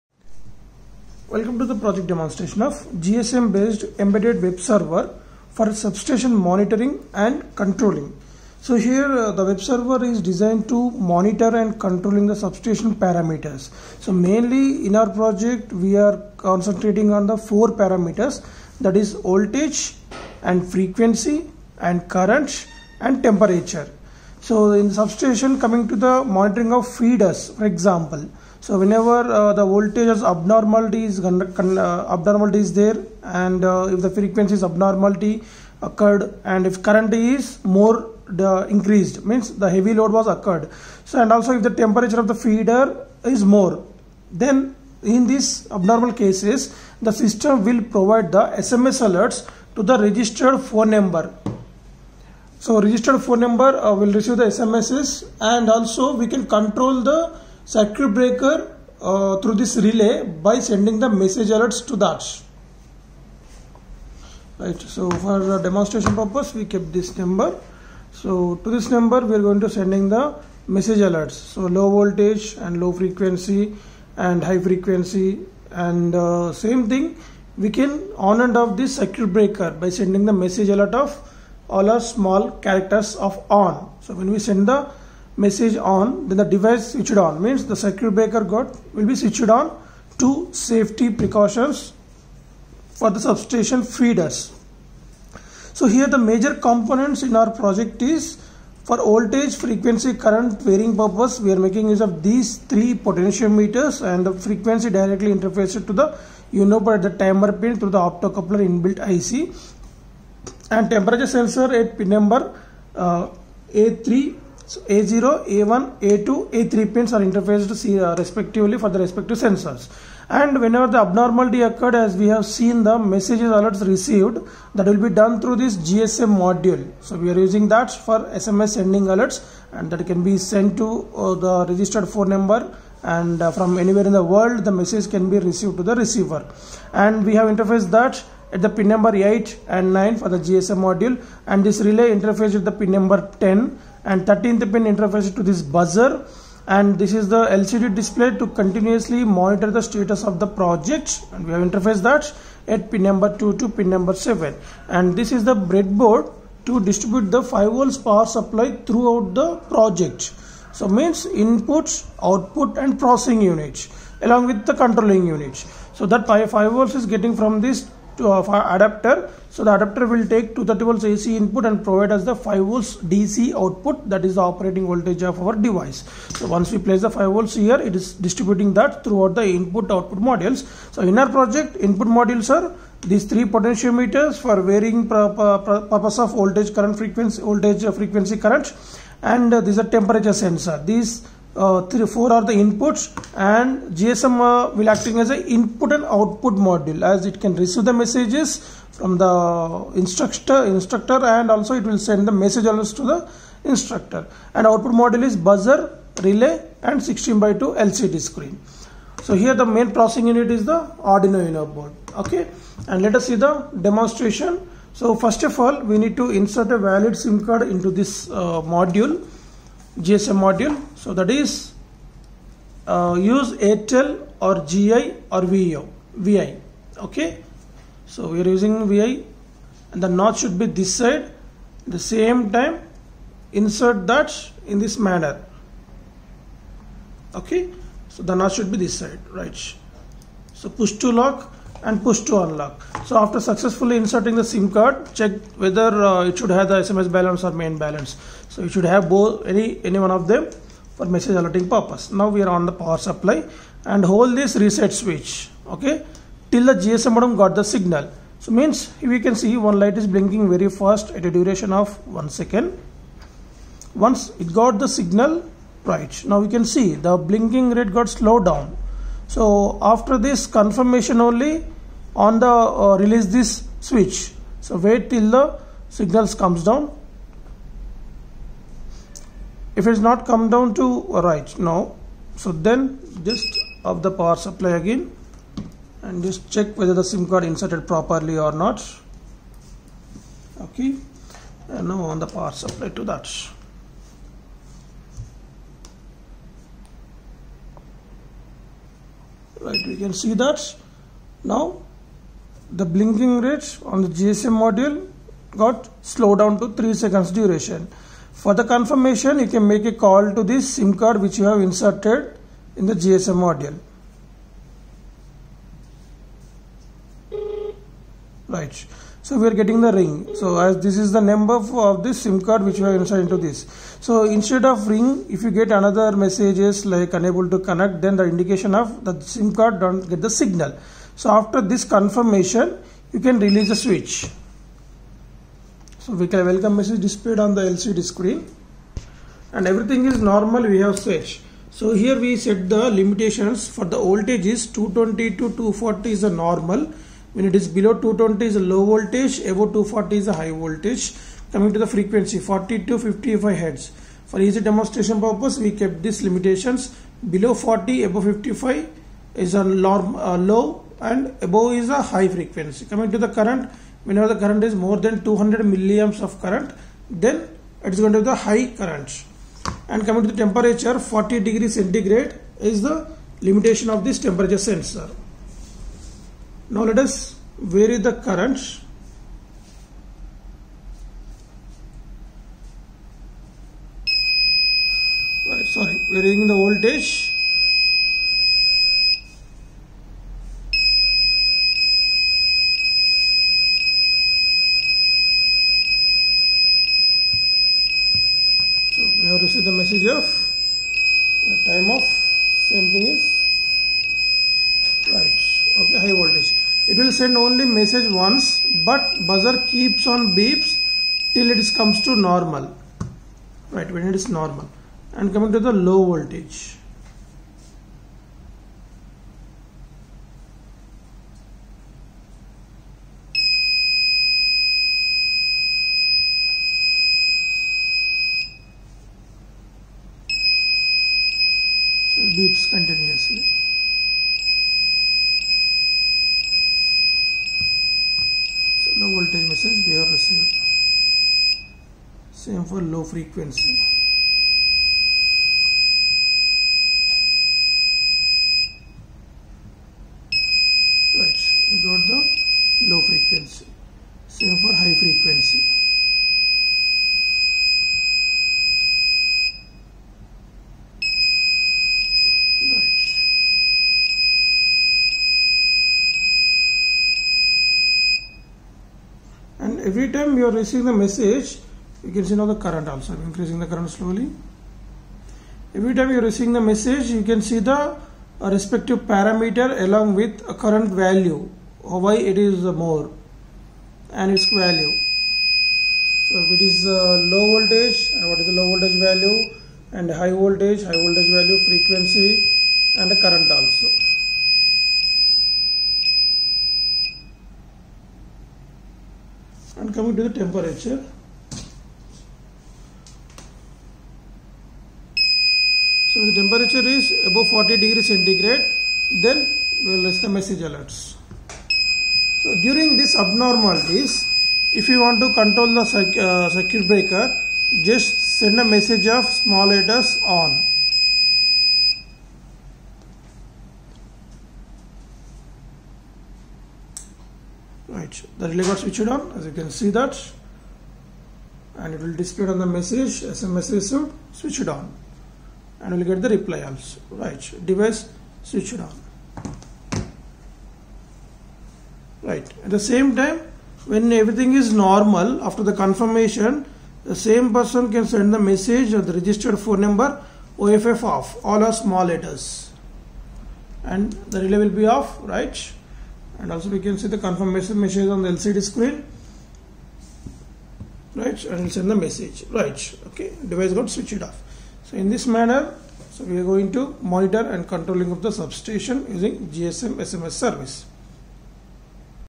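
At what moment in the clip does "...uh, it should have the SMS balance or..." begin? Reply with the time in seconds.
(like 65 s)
246 s.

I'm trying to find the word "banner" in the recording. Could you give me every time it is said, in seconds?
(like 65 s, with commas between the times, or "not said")
not said.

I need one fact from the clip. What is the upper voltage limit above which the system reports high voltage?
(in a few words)
240.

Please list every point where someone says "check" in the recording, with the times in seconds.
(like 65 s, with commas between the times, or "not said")
245 s, 286 s.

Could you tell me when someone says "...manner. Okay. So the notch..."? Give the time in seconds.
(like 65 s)
234 s.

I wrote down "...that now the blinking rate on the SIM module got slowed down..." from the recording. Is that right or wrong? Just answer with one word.
wrong.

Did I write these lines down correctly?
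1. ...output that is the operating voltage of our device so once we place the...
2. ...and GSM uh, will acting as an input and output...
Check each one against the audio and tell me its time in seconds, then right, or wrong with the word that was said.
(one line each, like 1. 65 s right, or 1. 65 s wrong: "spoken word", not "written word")
1. 173 s right
2. 193 s right.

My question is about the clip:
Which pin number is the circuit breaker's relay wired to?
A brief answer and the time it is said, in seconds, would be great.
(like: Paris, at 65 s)
10, at 142 s.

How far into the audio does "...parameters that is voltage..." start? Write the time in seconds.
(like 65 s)
17 s.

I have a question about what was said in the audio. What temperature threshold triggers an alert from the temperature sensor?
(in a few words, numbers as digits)
40 degrees centigrade.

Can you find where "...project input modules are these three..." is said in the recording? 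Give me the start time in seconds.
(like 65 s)
181 s.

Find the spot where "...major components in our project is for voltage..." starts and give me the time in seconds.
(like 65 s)
96 s.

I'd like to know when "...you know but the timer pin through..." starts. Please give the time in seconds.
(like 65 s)
106 s.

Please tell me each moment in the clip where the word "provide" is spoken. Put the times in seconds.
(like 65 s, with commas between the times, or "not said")
47 s, 171 s.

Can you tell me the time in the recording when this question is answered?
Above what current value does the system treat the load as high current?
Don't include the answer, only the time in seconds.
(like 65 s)
365 s.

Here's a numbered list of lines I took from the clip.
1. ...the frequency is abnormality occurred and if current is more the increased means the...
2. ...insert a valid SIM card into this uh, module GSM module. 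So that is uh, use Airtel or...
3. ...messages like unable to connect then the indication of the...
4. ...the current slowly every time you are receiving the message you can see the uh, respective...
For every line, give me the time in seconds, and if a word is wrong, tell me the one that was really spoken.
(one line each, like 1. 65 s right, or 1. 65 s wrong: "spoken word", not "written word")
1. 34 s right
2. 216 s right
3. 326 s right
4. 473 s right.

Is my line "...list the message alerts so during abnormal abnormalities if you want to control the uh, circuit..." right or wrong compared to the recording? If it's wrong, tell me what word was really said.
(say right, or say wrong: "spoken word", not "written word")
right.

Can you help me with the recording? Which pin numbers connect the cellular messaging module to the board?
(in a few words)
8 and 9.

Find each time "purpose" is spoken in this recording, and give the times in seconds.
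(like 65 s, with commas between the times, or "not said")
66 s, 100 s, 185 s, 251 s, 355 s.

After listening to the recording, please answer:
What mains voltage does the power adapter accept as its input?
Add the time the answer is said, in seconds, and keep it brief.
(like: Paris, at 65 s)
230 volts AC, at 170 s.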